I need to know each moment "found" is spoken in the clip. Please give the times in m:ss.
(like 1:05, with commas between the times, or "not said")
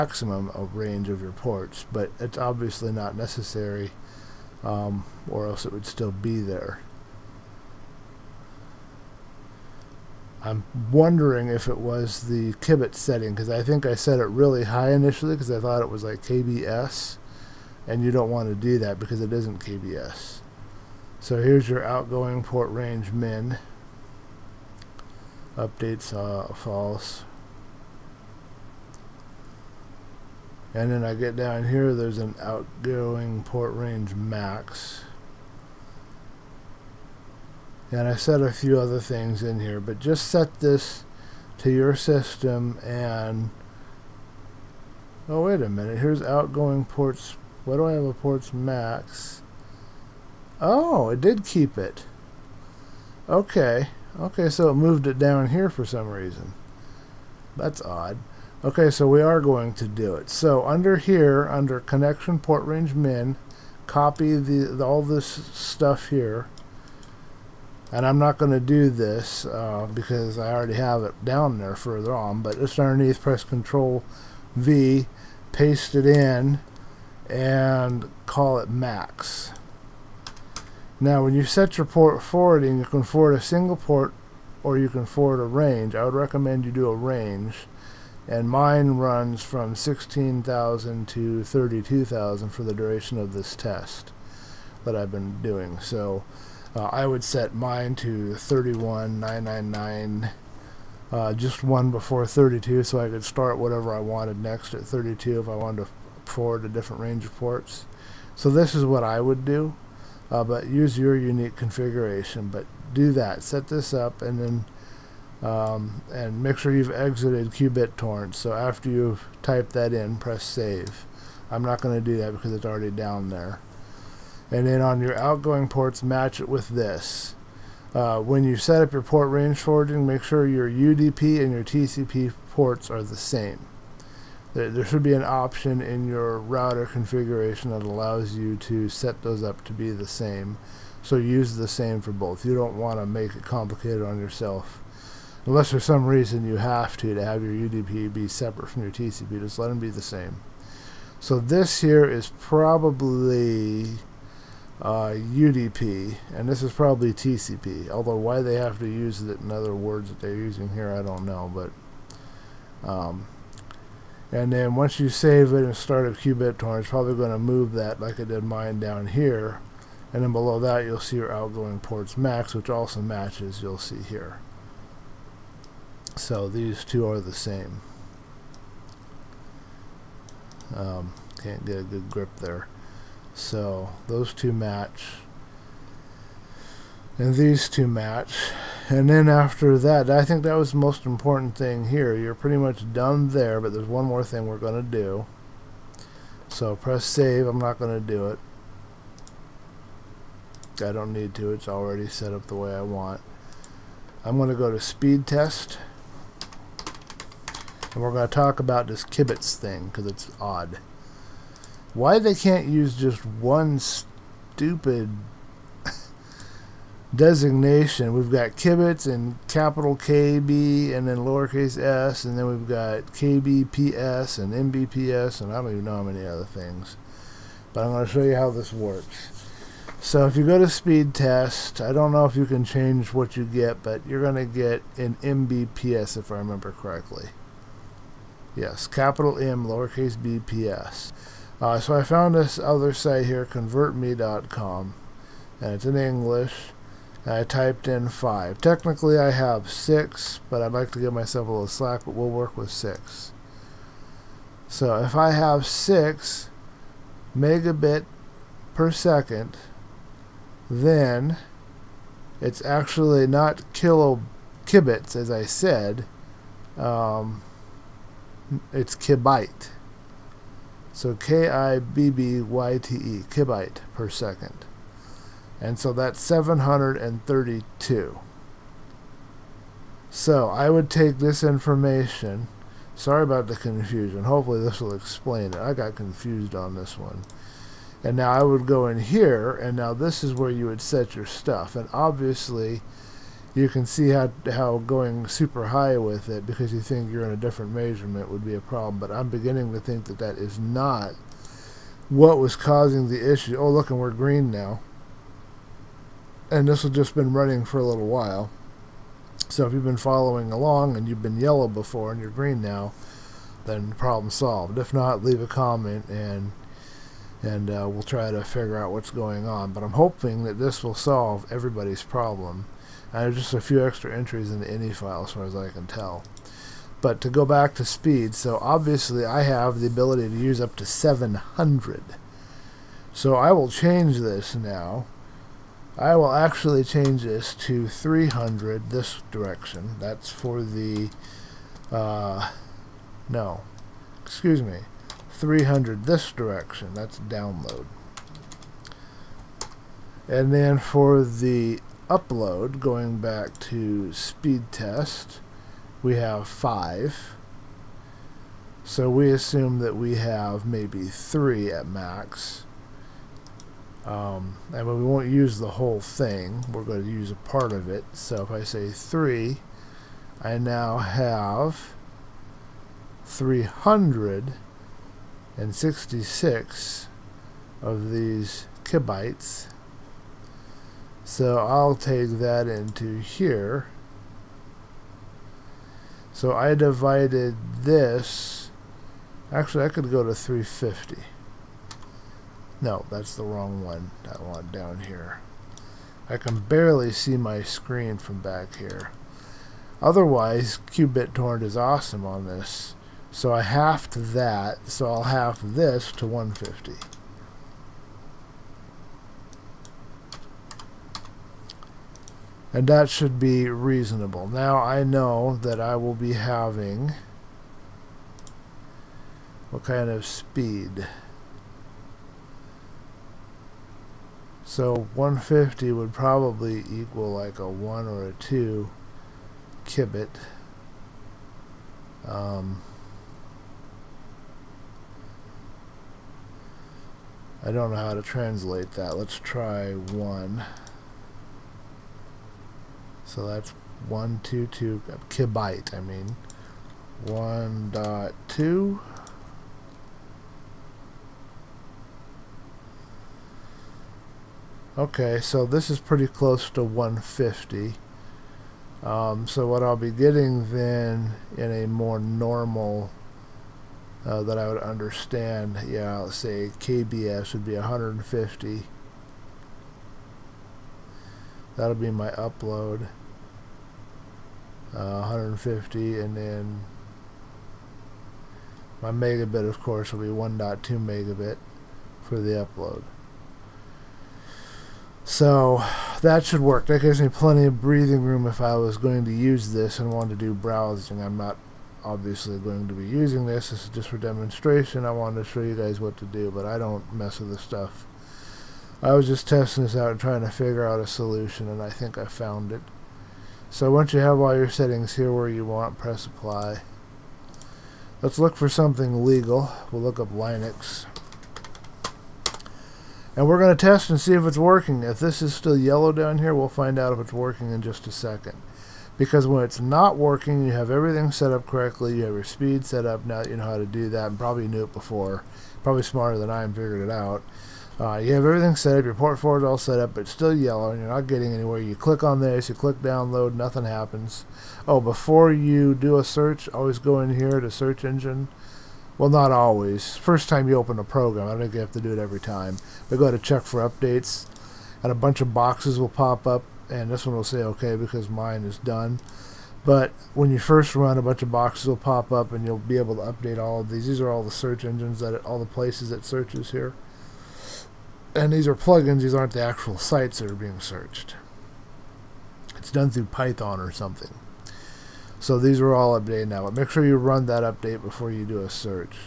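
4:02, 8:22.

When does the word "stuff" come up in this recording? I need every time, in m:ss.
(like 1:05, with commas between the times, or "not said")
1:05, 4:51, 8:17.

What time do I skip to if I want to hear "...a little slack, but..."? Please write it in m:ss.
4:11.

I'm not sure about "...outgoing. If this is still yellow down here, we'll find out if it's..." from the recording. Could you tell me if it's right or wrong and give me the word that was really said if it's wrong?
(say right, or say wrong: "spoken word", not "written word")
wrong: "working", not "outgoing".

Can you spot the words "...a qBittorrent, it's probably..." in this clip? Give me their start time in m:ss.
2:46.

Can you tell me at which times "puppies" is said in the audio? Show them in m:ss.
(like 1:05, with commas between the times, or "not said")
not said.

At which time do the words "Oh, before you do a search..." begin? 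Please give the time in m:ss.
8:54.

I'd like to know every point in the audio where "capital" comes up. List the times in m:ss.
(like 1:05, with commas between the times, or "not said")
3:39, 3:58.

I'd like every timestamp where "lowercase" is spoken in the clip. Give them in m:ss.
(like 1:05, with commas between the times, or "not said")
3:41, 3:59.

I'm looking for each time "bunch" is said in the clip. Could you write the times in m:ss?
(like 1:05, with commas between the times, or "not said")
9:05, 9:11.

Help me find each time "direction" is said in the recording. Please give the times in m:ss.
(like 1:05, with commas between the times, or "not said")
5:39, 5:46.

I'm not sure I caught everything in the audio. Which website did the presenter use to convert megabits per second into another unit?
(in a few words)
convertme.com.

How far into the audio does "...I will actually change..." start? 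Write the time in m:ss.
5:35.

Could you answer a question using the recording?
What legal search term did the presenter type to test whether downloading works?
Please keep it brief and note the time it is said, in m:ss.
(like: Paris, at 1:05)
Linux, at 8:30.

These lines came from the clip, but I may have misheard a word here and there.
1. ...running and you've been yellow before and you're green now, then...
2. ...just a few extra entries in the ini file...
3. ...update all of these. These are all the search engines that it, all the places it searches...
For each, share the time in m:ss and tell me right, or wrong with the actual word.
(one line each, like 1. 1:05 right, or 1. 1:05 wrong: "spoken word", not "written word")
1. 5:10 wrong: "along", not "running"
2. 5:23 right
3. 9:13 right.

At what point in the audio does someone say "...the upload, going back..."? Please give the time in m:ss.
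5:51.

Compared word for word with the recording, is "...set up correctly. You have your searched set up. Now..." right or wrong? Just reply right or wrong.
wrong.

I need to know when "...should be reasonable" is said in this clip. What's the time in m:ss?
6:53.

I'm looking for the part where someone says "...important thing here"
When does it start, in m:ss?
3:11.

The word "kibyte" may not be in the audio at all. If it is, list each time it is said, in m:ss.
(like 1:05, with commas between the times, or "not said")
4:28, 4:33, 7:25.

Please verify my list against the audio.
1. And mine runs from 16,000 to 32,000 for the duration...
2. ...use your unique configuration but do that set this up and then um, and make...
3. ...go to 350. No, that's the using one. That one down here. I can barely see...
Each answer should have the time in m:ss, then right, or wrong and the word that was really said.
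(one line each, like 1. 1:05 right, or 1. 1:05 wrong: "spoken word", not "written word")
1. 1:28 right
2. 1:50 right
3. 6:30 wrong: "wrong", not "using".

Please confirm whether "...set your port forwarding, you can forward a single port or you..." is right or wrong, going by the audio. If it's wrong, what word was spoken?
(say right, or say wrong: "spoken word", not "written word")
right.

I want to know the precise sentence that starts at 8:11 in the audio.
I'm not obviously going to be using this.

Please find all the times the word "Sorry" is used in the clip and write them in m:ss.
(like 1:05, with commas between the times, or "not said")
4:42.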